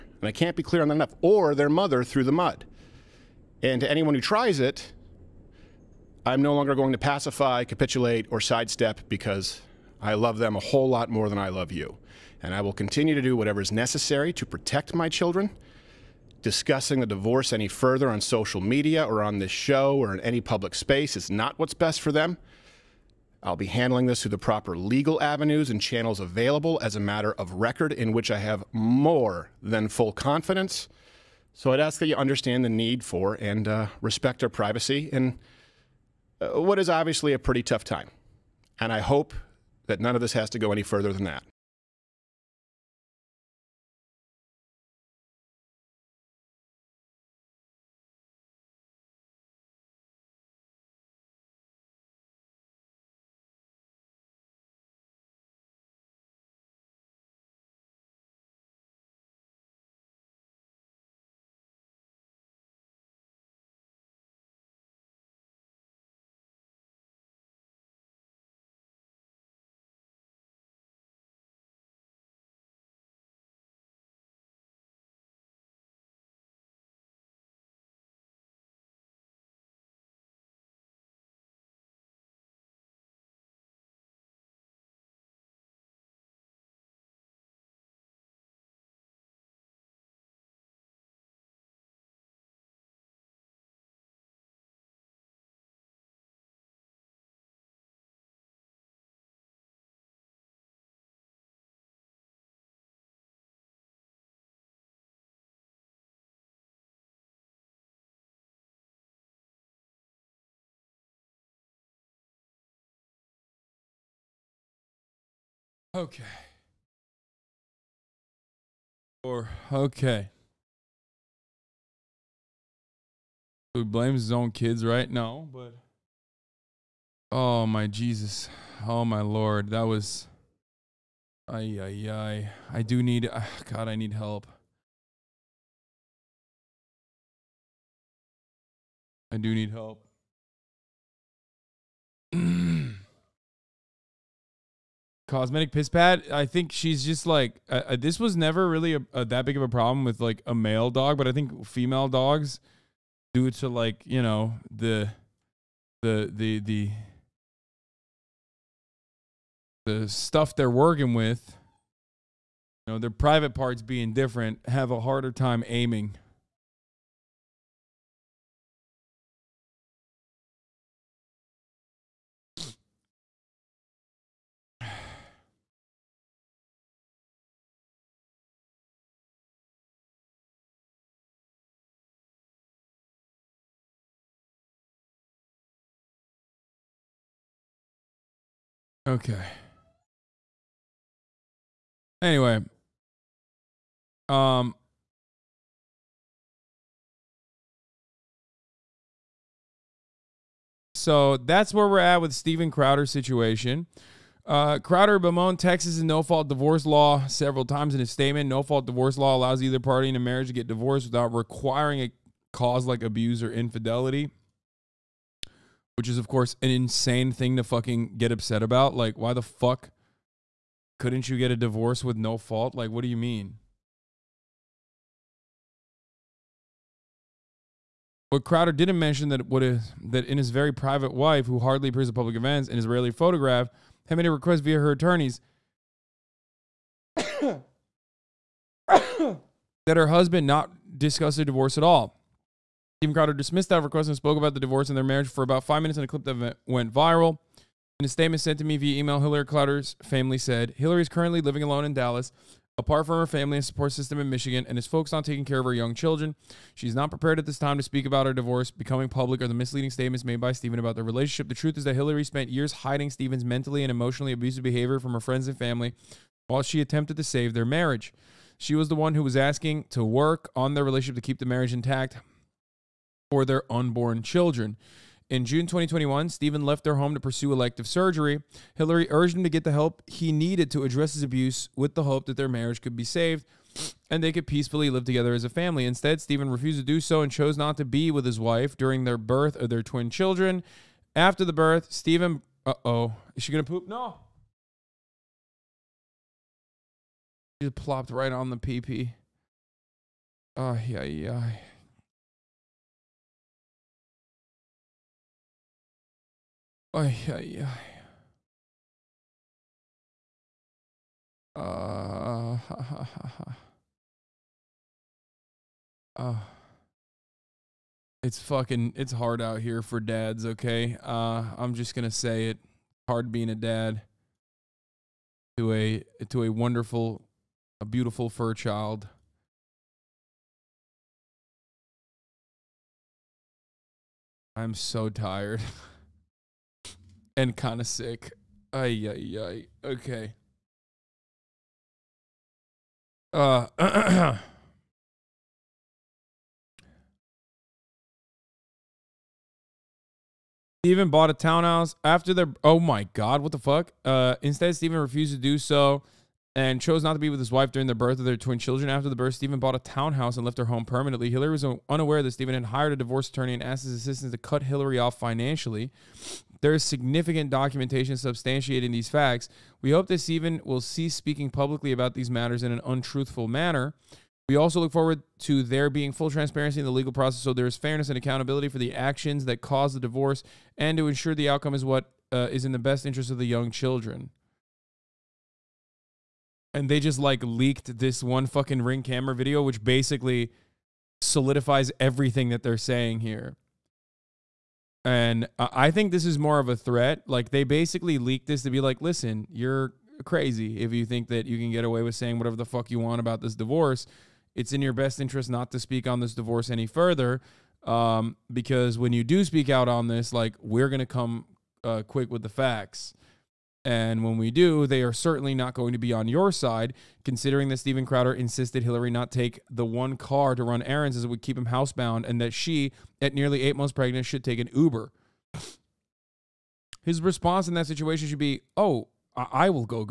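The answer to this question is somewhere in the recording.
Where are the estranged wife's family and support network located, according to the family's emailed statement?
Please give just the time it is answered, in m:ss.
4:14.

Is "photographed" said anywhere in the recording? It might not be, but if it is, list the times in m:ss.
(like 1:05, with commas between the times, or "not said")
3:53.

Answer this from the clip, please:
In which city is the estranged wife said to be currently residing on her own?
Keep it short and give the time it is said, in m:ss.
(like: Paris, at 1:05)
Dallas, at 4:11.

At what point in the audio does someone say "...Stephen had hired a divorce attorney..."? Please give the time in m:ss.
6:02.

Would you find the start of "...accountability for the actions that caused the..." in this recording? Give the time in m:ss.
6:18.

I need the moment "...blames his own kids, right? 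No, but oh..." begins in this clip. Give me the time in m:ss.
2:03.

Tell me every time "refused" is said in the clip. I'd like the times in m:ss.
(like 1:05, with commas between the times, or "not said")
4:46, 5:54.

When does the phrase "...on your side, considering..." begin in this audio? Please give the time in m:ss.
6:56.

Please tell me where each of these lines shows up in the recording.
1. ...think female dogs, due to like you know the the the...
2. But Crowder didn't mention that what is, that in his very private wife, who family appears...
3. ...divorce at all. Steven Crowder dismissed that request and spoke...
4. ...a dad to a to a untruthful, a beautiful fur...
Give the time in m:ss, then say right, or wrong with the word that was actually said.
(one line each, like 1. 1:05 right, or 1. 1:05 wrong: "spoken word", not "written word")
1. 2:31 right
2. 3:48 wrong: "hardly", not "family"
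3. 4:01 right
4. 5:23 wrong: "wonderful", not "untruthful".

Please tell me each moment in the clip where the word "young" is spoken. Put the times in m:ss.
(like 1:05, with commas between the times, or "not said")
4:15, 6:23.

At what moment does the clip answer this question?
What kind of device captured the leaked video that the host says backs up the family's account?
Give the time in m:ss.
6:28.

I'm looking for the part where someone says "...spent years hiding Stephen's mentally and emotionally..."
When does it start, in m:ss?
4:22.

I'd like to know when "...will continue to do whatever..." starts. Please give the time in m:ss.
0:12.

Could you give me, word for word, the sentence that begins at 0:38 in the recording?
And I hope that none of this has to go any further than that.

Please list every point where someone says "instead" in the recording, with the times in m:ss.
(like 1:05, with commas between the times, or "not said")
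4:45, 5:54.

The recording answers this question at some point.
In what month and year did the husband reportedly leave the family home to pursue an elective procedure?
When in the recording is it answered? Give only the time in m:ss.
4:35.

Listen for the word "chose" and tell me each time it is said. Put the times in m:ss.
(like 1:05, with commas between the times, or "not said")
4:47, 5:56.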